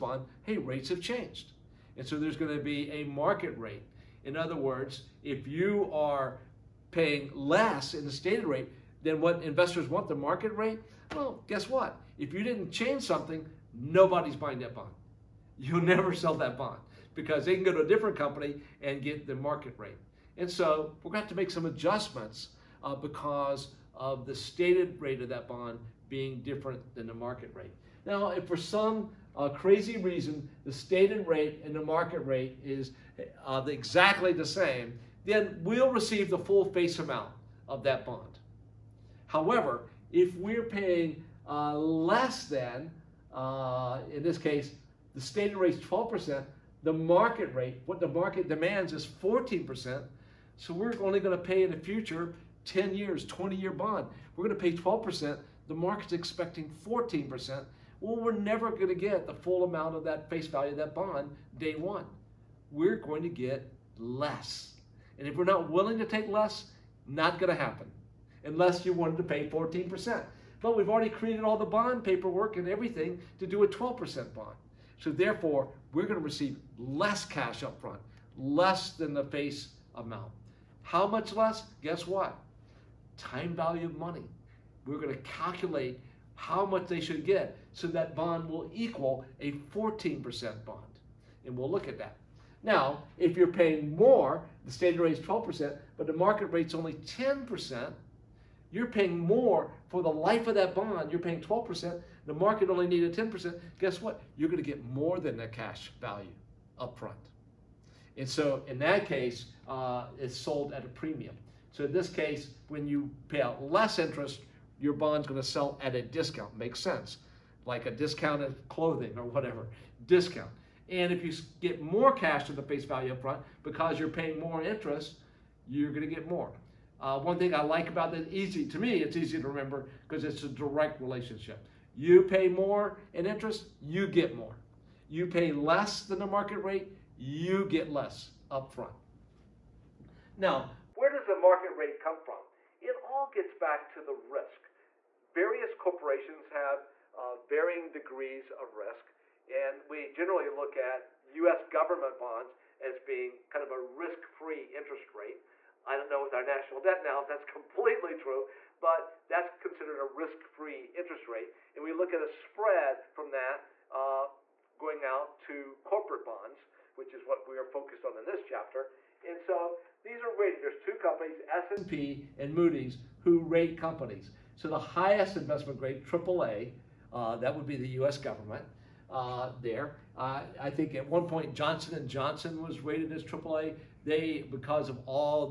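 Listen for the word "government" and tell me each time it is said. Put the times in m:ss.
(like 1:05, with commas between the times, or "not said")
2:31, 2:58.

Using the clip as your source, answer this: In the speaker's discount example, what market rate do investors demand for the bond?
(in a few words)
14%.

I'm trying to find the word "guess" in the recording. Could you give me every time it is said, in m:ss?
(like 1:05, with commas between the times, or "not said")
0:11, 1:21, 1:43.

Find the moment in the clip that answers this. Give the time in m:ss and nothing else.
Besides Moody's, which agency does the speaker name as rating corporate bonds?
2:51.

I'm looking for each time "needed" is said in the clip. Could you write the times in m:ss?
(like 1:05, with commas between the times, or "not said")
1:42.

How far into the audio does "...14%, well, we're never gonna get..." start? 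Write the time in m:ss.
0:56.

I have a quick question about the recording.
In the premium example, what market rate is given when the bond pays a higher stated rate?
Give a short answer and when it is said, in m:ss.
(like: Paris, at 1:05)
10%, at 1:36.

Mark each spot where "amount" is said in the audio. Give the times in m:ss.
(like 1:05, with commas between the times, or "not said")
0:36, 0:59, 1:19.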